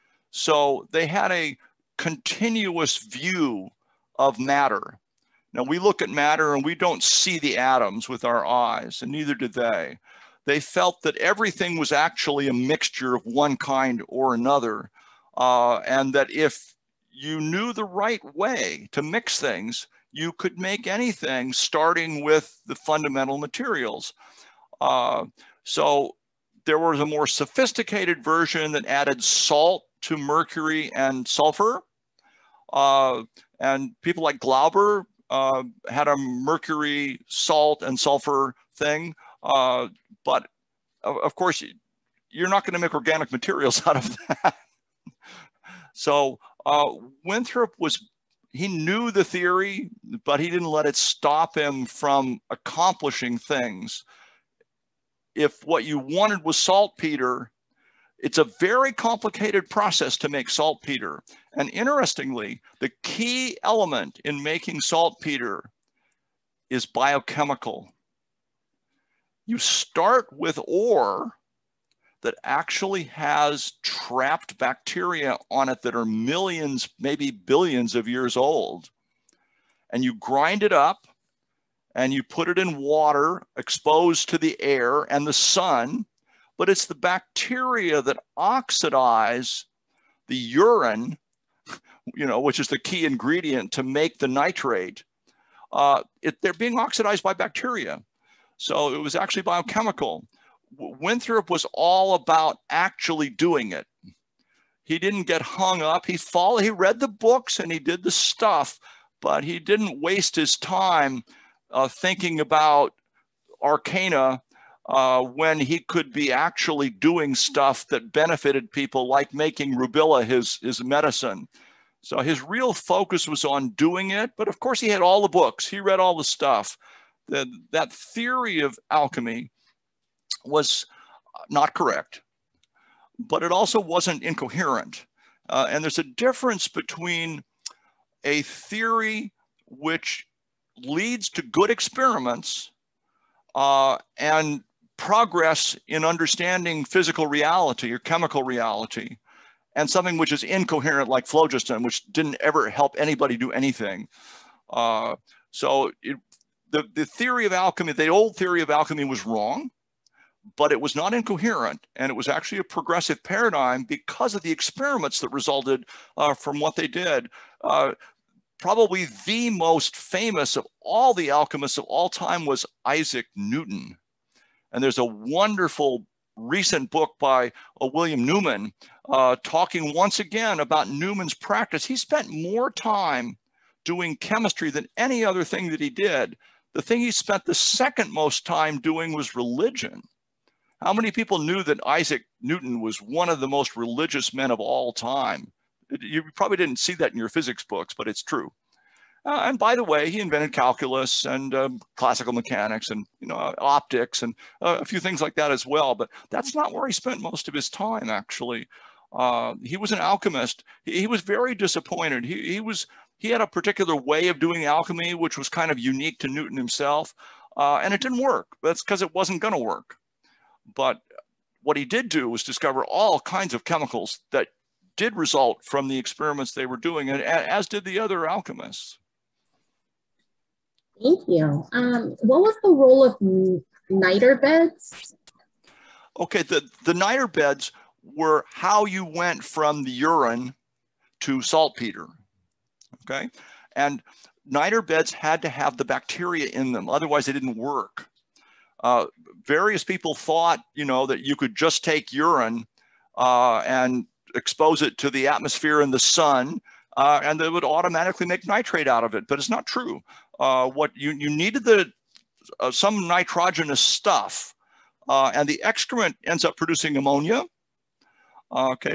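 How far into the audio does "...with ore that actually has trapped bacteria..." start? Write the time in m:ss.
1:10.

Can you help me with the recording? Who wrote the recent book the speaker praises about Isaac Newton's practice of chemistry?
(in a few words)
William Newman.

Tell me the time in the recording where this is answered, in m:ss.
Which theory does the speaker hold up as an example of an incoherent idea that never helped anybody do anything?
2:31.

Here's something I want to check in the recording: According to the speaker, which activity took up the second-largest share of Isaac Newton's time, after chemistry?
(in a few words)
religion.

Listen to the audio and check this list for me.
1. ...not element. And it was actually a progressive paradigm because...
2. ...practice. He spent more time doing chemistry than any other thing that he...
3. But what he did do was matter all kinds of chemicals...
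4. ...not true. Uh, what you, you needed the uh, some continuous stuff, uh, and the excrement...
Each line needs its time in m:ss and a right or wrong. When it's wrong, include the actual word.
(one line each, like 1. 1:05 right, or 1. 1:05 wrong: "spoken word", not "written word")
1. 2:40 wrong: "incoherent", not "element"
2. 3:01 right
3. 3:40 wrong: "discover", not "matter"
4. 4:19 wrong: "nitrogenous", not "continuous".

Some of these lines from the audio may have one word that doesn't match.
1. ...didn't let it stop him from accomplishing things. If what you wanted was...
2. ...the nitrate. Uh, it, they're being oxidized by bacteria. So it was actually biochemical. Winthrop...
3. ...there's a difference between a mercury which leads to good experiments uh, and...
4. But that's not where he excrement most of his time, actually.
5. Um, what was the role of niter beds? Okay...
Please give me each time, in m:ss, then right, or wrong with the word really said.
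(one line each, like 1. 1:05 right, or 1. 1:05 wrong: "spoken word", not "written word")
1. 0:50 right
2. 1:34 right
3. 2:15 wrong: "theory", not "mercury"
4. 3:25 wrong: "spent", not "excrement"
5. 3:51 right.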